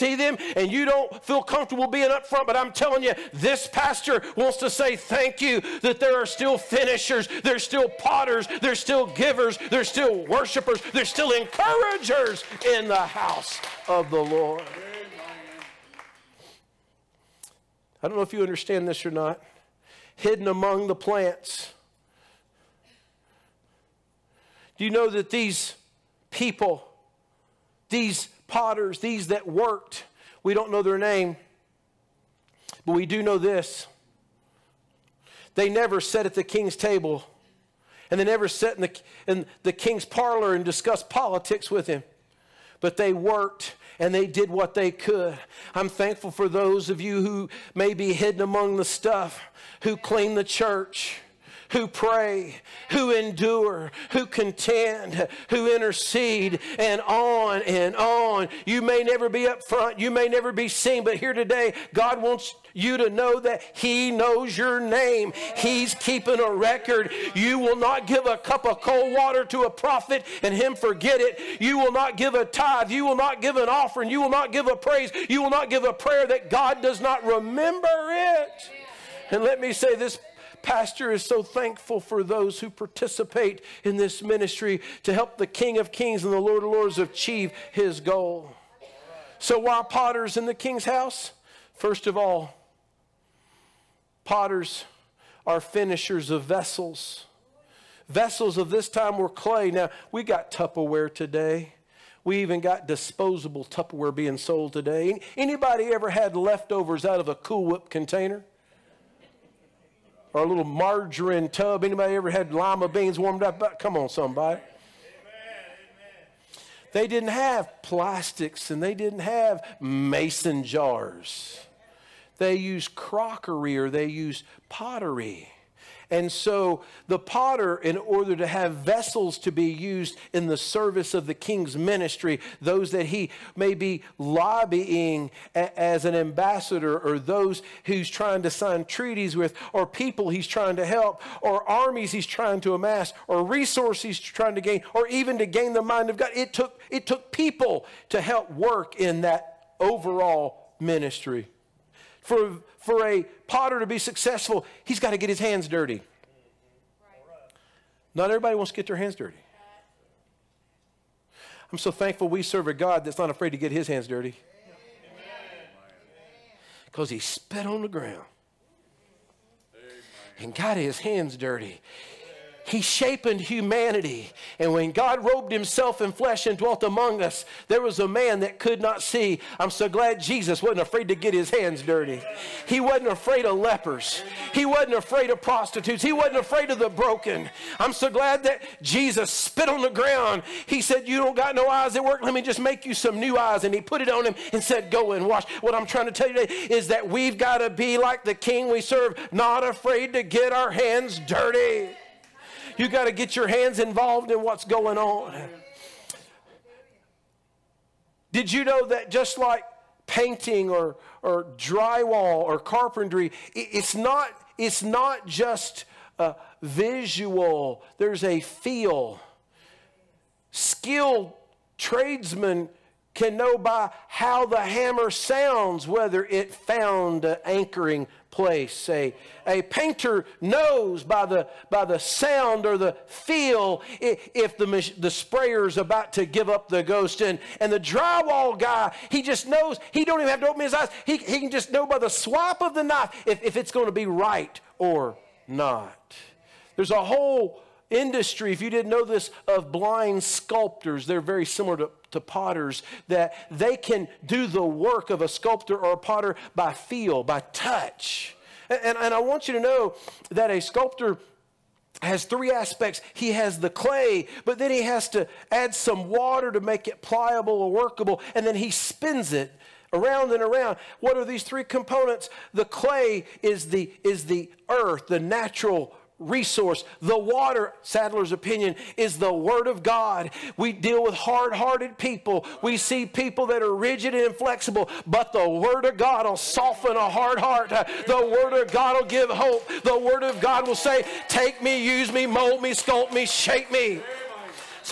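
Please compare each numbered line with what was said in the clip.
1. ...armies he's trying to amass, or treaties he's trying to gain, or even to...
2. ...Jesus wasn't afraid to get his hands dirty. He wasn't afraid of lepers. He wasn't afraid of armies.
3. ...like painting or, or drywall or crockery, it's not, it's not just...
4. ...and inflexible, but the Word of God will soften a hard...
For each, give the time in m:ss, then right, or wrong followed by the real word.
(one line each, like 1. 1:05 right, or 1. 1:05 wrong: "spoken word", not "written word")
1. 2:21 wrong: "resources", not "treaties"
2. 3:00 wrong: "prostitutes", not "armies"
3. 3:29 wrong: "carpentry", not "crockery"
4. 4:44 right.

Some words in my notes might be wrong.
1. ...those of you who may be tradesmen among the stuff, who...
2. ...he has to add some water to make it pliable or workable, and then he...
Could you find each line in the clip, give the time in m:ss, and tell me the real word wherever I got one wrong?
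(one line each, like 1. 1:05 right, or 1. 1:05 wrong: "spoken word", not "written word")
1. 0:46 wrong: "hidden", not "tradesmen"
2. 4:24 right.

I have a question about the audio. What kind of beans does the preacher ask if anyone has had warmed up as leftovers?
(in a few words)
lima beans.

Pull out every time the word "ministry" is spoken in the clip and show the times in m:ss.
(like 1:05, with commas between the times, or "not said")
1:24, 2:11, 2:30.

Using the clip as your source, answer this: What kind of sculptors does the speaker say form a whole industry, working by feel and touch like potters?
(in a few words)
blind sculptors.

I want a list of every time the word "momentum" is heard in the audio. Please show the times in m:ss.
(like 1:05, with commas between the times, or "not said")
not said.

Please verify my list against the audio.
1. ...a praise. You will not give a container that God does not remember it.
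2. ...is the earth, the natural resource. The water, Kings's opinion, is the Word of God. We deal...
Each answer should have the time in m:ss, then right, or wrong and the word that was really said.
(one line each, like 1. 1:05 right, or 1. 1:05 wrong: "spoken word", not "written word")
1. 1:14 wrong: "prayer", not "container"
2. 4:34 wrong: "Saddler", not "Kings".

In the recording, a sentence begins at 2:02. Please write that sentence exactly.
They used crockery or they used pottery.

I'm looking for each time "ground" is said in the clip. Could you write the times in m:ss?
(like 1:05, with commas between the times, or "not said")
2:47, 3:09.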